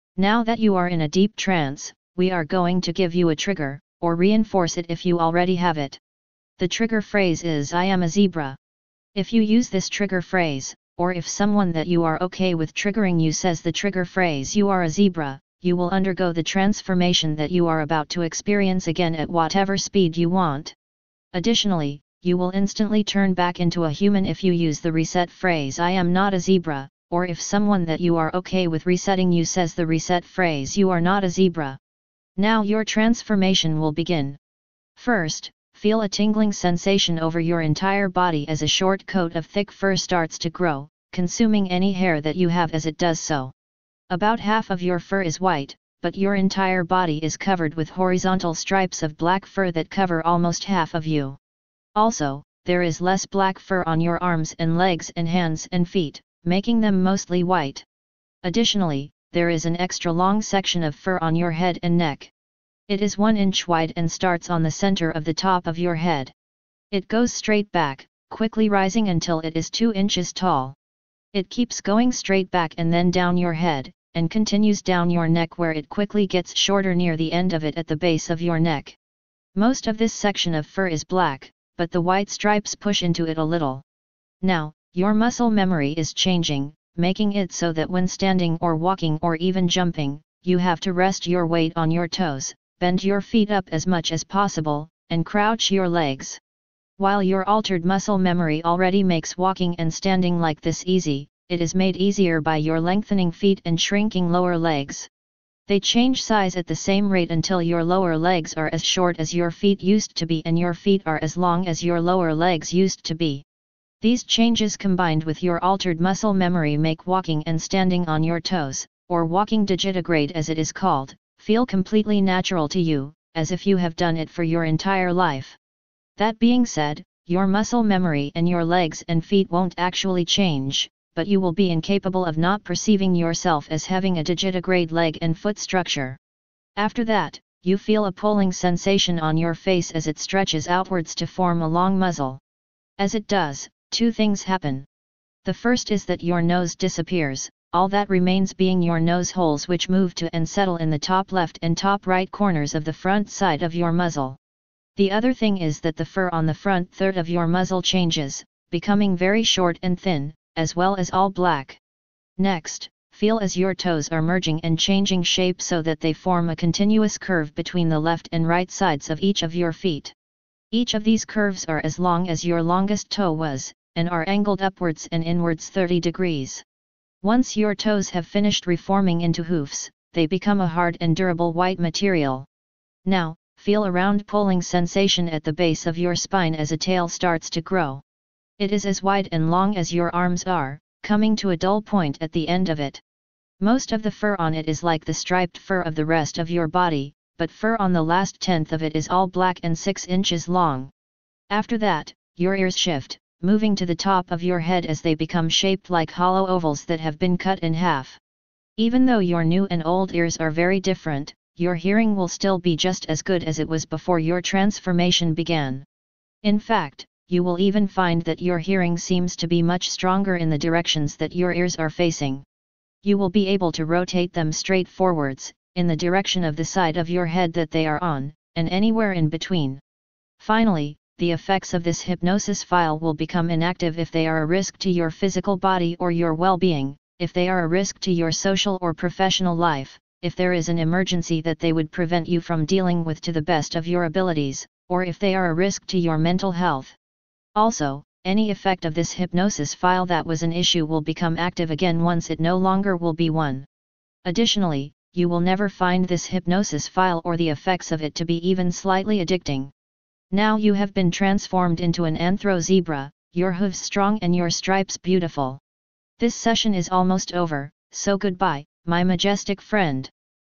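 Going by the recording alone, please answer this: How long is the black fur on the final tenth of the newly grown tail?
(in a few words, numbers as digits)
6 inches.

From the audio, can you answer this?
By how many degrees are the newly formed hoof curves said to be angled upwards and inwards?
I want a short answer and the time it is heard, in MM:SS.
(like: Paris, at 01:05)
30, at 02:55.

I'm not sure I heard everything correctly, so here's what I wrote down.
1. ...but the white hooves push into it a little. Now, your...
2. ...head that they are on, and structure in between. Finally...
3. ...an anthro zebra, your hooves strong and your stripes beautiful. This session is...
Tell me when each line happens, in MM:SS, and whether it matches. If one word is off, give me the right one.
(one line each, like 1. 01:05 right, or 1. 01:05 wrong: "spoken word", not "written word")
1. 01:21 wrong: "stripes", not "hooves"
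2. 03:47 wrong: "anywhere", not "structure"
3. 04:22 right.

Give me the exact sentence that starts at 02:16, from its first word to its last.
After that, you feel a pulling sensation on your face as it stretches outwards to form a long muzzle.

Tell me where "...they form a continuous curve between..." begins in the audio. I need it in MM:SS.
02:45.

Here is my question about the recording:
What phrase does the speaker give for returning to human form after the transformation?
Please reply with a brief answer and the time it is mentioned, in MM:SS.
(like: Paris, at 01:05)
I am not a zebra, at 00:25.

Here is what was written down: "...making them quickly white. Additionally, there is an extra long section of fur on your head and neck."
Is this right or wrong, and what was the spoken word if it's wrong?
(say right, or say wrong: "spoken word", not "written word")
wrong: "mostly", not "quickly".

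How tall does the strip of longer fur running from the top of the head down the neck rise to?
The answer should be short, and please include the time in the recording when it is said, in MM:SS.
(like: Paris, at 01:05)
2 inches, at 01:09.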